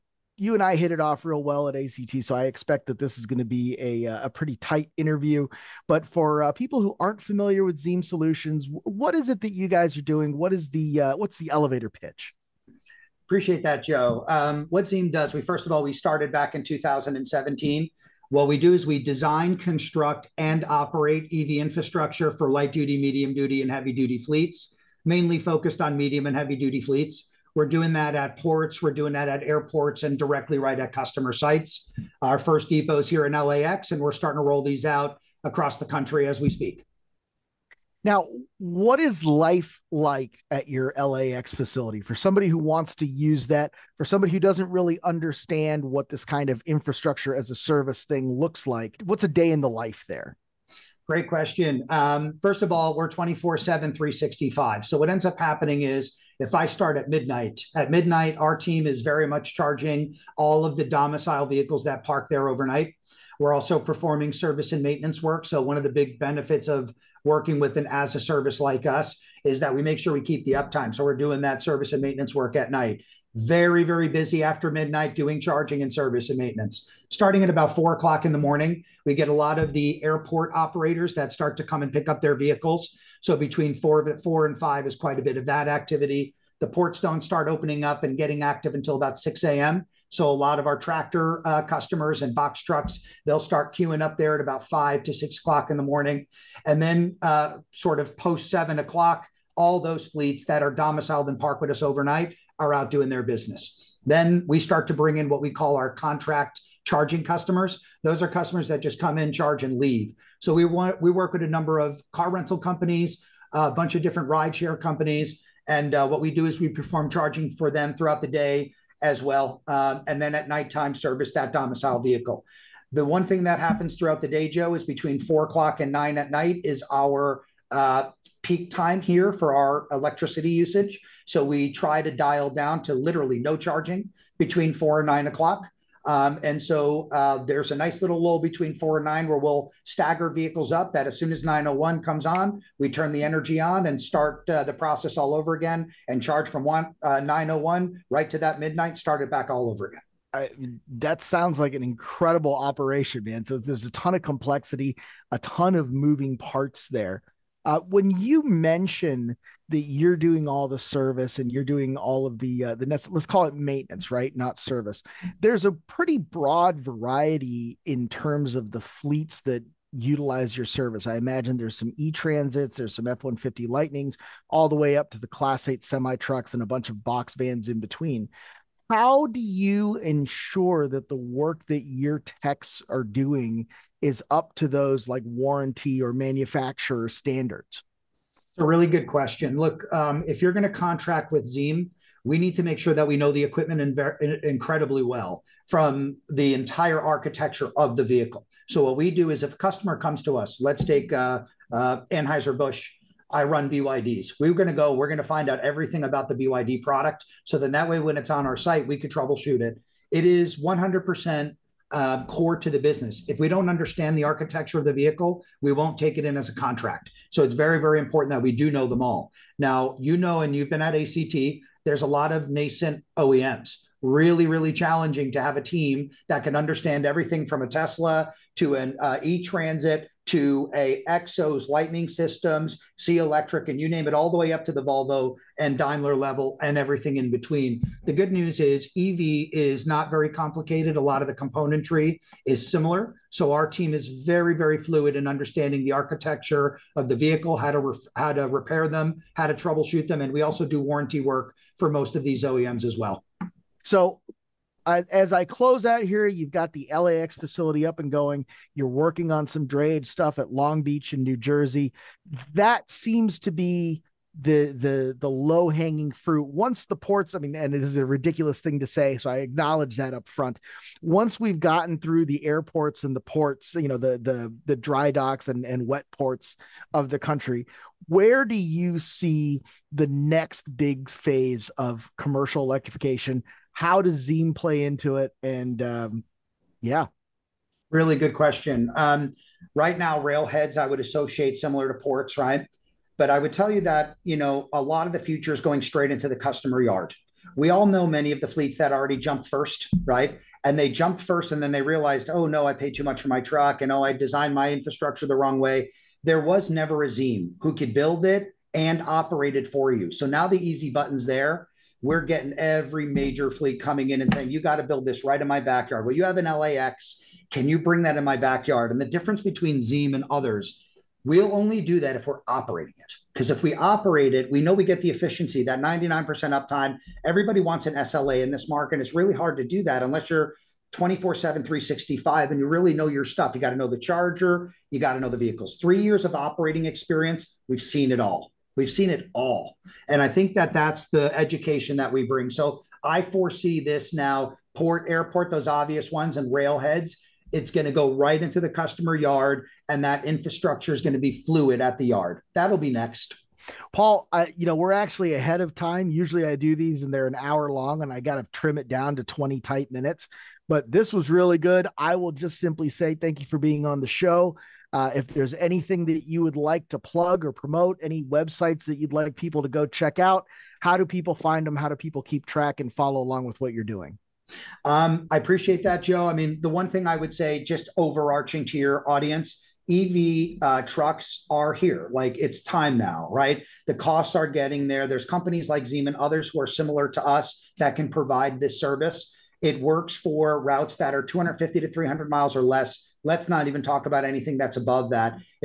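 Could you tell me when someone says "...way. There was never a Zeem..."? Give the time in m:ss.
5:05.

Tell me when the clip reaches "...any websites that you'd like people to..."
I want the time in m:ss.
6:08.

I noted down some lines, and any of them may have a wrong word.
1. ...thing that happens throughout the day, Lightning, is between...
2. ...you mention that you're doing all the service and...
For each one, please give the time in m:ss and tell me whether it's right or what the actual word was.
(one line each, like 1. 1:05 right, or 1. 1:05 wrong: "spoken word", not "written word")
1. 2:03 wrong: "Joe", not "Lightning"
2. 2:38 right.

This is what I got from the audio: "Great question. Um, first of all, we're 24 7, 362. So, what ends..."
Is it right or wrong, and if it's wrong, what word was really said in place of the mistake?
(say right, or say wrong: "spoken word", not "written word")
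wrong: "365", not "362".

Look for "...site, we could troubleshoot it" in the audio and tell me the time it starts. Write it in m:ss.
3:28.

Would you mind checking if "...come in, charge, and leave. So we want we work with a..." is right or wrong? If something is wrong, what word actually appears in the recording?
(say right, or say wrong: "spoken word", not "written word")
right.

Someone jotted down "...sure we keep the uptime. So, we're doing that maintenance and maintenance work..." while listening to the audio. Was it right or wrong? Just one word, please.
wrong.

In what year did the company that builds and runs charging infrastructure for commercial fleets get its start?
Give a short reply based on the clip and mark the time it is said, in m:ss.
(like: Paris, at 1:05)
2017, at 0:16.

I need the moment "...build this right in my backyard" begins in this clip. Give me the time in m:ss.
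5:14.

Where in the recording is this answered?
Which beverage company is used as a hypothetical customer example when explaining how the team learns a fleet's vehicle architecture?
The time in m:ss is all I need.
3:22.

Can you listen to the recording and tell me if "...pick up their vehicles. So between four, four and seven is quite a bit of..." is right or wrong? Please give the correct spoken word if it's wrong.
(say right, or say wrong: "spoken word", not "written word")
wrong: "five", not "seven".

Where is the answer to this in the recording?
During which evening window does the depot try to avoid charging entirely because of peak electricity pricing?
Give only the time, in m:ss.
2:14.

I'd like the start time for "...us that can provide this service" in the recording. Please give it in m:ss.
6:27.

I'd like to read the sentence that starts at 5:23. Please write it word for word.
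Because if we operate it, we know we get the efficiency, that 99% uptime.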